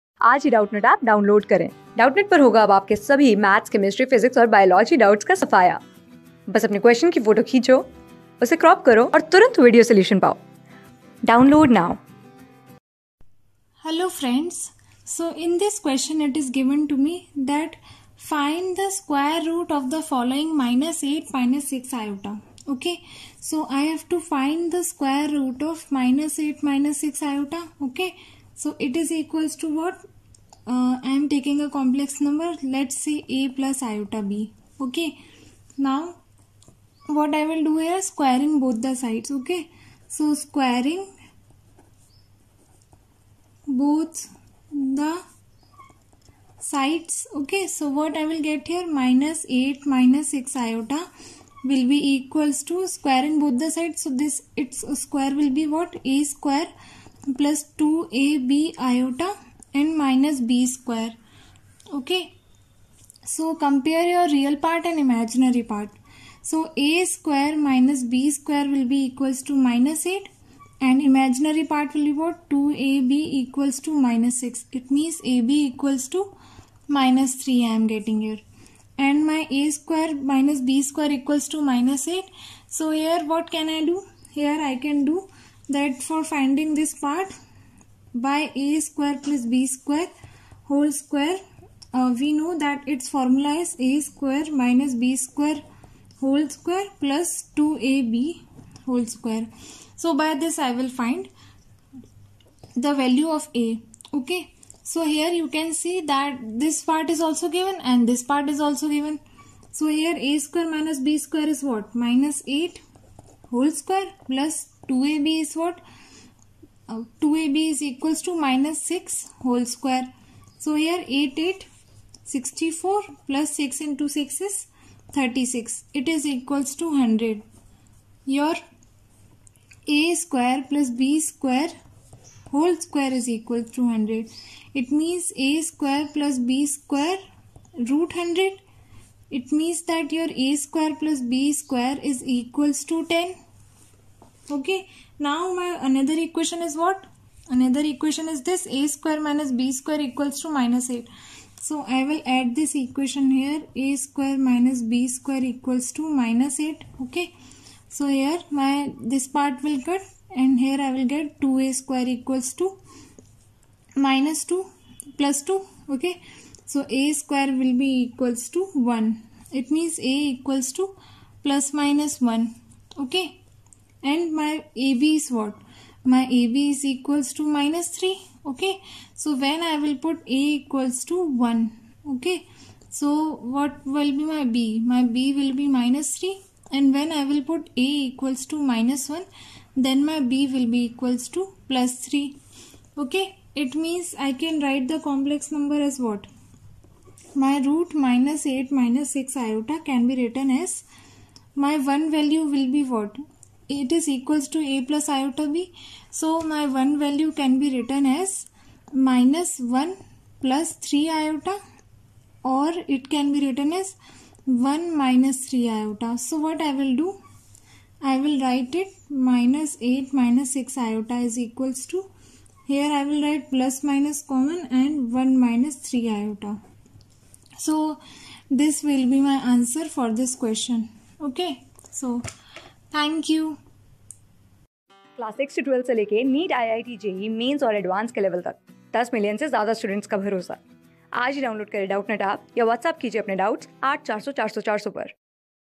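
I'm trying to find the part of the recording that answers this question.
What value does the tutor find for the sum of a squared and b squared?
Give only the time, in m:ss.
2:20.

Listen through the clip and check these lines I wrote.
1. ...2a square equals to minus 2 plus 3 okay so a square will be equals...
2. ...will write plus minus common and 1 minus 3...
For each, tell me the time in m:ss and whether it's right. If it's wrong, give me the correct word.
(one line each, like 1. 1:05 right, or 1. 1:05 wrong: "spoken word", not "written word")
1. 2:41 wrong: "2", not "3"
2. 3:43 right.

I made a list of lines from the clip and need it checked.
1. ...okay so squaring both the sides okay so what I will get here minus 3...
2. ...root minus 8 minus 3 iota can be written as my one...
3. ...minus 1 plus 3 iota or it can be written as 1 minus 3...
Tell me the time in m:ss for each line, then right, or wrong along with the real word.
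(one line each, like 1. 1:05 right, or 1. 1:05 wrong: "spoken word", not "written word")
1. 0:39 wrong: "8", not "3"
2. 3:17 wrong: "6", not "3"
3. 3:28 right.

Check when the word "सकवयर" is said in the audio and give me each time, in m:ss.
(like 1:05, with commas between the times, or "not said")
0:18, 0:24.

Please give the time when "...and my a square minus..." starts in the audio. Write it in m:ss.
1:18.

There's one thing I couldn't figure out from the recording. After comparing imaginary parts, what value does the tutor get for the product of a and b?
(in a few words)
-3.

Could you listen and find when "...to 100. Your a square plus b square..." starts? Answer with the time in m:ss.
2:06.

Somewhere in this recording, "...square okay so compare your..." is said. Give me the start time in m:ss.
1:00.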